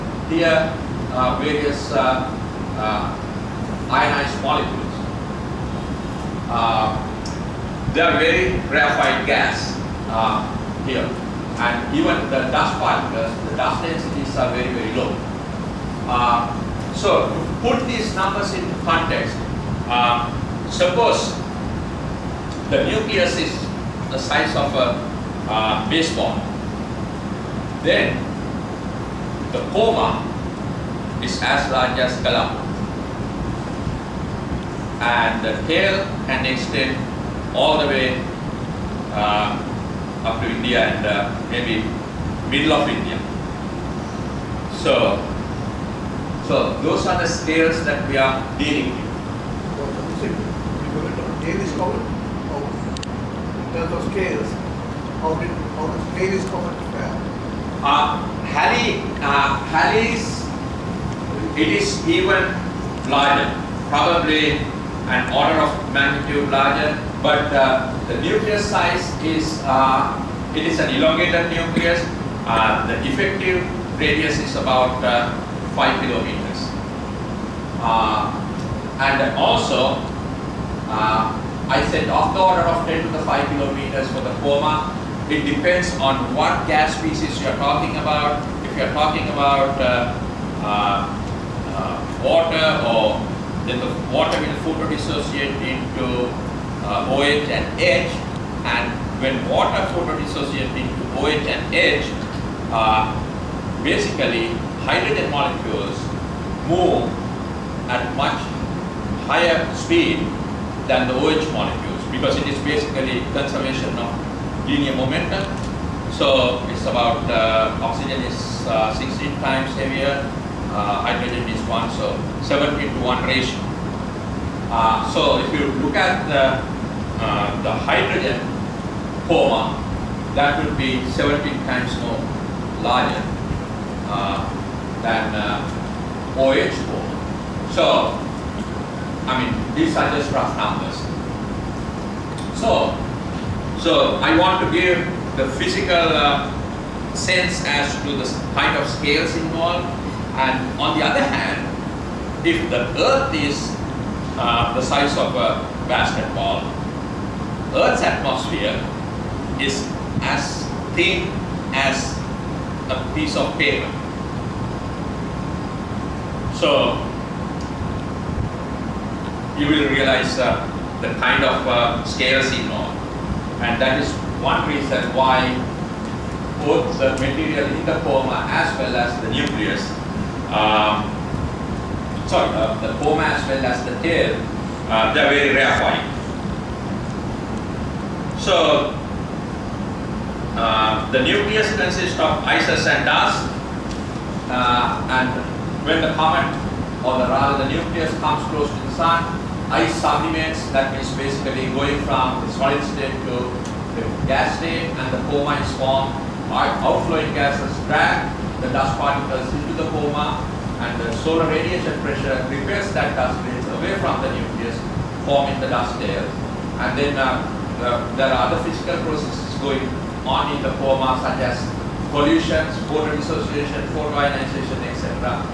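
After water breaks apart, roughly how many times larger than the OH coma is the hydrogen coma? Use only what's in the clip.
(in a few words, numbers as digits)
17.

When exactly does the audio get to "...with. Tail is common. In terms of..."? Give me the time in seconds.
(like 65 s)
48 s.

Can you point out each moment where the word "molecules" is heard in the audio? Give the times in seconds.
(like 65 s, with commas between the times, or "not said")
4 s, 105 s, 111 s.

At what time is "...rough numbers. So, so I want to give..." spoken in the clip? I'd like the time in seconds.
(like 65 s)
140 s.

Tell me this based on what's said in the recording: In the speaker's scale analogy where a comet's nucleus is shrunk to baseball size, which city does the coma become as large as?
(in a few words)
Colombo.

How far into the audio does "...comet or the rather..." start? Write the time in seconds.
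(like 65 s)
196 s.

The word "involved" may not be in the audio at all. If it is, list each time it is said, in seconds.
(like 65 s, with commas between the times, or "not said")
149 s, 172 s.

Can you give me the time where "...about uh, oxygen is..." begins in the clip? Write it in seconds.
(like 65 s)
116 s.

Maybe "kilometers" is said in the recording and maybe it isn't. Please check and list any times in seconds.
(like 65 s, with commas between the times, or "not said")
76 s, 83 s.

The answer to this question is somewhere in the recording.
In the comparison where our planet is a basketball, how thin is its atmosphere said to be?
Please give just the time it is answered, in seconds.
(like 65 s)
162 s.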